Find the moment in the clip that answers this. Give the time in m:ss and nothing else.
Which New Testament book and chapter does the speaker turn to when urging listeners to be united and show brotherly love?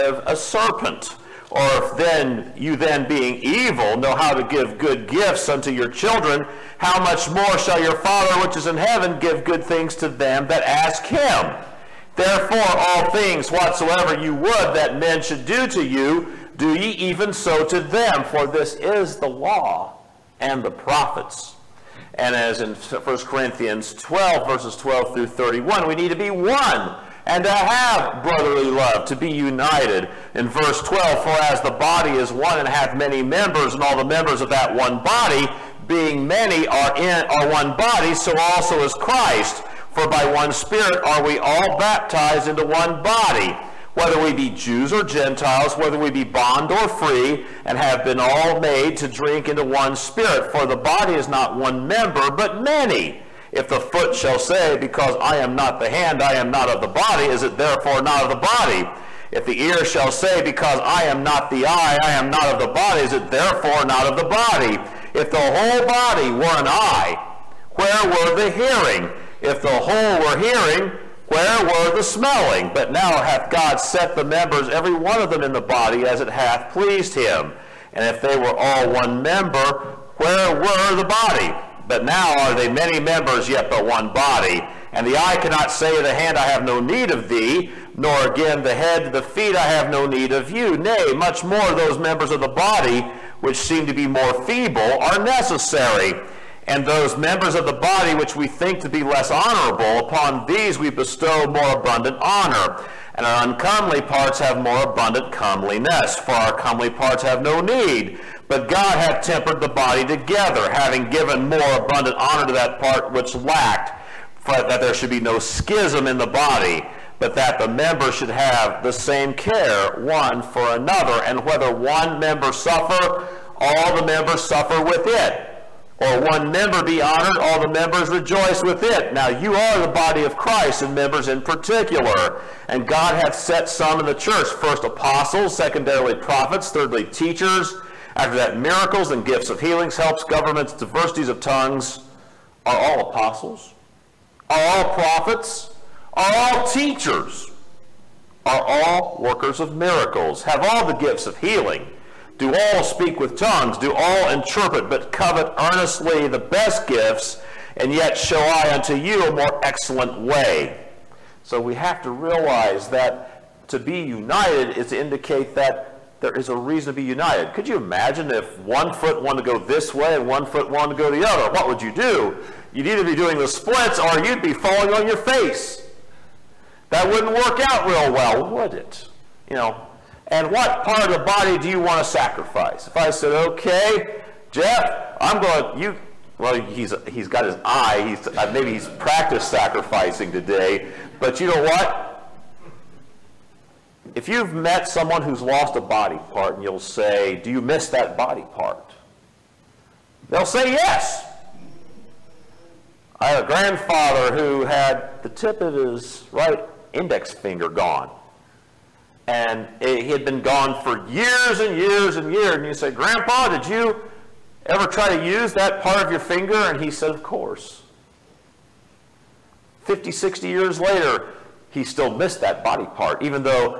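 0:22.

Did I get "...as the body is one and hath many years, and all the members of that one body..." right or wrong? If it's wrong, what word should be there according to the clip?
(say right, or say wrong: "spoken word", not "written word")
wrong: "members", not "years".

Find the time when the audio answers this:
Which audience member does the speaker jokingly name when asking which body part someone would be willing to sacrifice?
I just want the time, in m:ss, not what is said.
3:04.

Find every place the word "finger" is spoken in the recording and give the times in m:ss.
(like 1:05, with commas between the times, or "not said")
3:27, 3:36.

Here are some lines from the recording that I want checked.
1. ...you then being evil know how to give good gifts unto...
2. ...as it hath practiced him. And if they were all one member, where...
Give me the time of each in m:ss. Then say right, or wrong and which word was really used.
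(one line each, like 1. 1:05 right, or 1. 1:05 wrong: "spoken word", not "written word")
1. 0:02 right
2. 1:16 wrong: "pleased", not "practiced".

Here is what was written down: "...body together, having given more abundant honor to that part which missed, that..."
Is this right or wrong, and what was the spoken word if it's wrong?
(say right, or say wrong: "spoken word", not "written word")
wrong: "lacked", not "missed".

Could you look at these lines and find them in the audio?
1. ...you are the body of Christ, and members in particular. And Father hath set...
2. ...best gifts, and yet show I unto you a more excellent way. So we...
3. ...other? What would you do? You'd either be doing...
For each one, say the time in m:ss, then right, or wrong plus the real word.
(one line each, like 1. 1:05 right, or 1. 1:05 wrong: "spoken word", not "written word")
1. 2:09 wrong: "God", not "Father"
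2. 2:36 right
3. 2:51 right.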